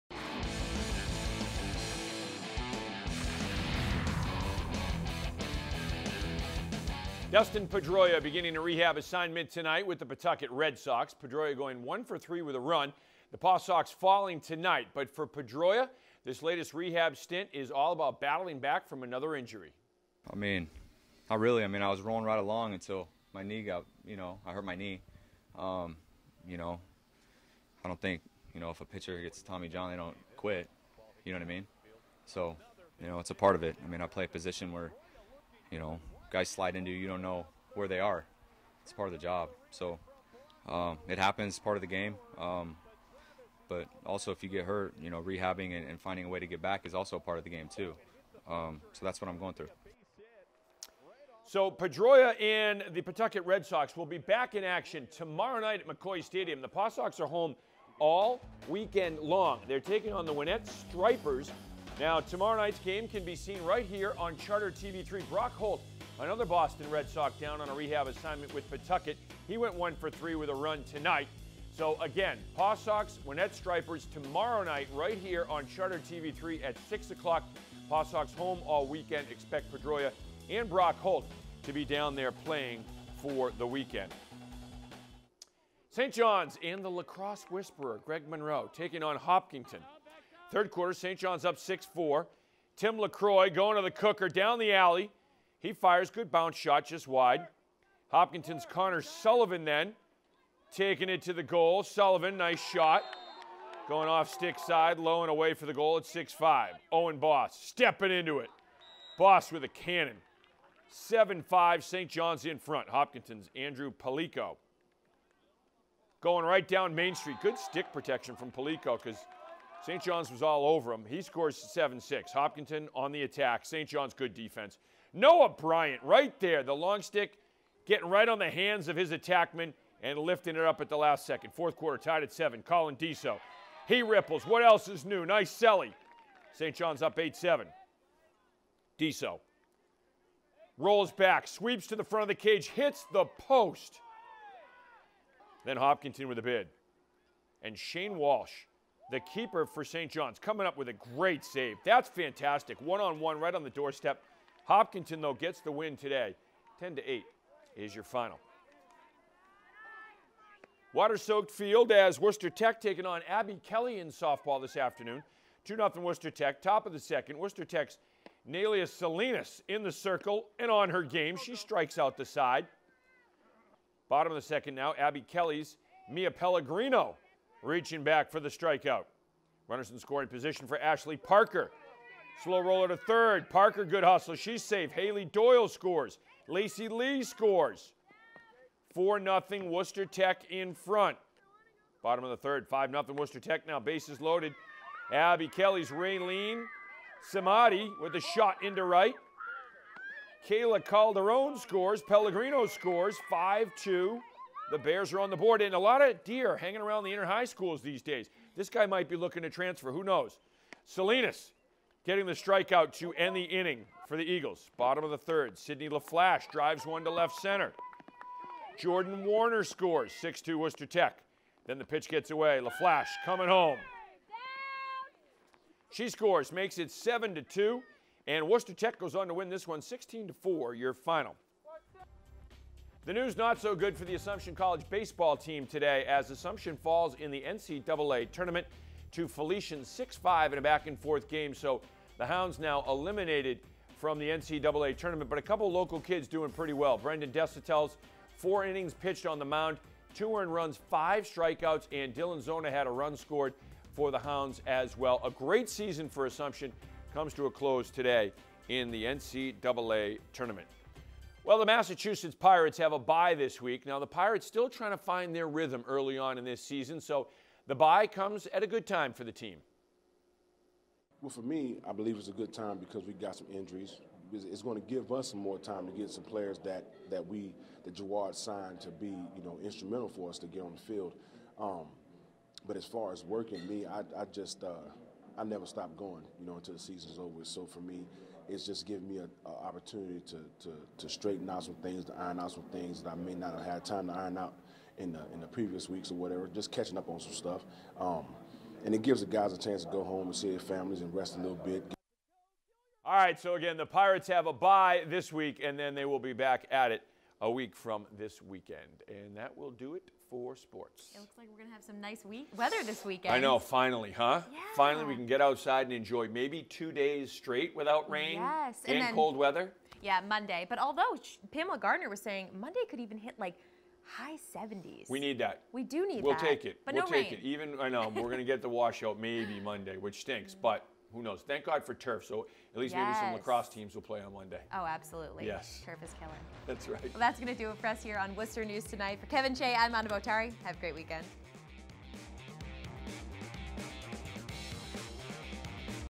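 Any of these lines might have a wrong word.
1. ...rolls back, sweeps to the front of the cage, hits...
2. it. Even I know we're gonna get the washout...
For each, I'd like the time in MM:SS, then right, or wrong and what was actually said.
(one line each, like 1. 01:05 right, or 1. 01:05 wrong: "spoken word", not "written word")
1. 02:20 right
2. 05:27 right.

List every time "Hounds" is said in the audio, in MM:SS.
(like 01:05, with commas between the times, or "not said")
04:02, 04:14.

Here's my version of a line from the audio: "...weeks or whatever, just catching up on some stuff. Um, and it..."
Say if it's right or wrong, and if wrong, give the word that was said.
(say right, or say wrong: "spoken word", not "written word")
right.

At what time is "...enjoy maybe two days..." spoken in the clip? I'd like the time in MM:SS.
05:15.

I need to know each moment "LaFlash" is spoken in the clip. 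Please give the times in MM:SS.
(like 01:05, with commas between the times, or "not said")
03:35, 03:42.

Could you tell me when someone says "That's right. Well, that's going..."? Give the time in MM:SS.
05:36.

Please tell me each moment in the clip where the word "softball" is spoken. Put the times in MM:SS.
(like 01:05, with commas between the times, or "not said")
02:44.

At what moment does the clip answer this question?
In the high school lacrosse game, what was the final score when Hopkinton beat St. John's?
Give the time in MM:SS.
02:36.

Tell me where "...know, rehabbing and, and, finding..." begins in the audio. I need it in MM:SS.
00:45.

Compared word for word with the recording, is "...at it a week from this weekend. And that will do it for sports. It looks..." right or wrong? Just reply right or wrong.
right.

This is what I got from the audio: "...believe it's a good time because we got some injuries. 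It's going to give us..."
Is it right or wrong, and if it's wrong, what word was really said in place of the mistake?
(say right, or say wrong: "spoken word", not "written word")
right.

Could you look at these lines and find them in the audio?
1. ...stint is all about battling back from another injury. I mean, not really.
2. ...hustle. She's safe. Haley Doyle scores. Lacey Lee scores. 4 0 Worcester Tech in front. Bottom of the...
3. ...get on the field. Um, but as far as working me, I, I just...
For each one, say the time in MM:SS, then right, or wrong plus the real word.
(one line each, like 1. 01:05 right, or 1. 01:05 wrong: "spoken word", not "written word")
1. 00:17 right
2. 03:04 right
3. 04:40 right.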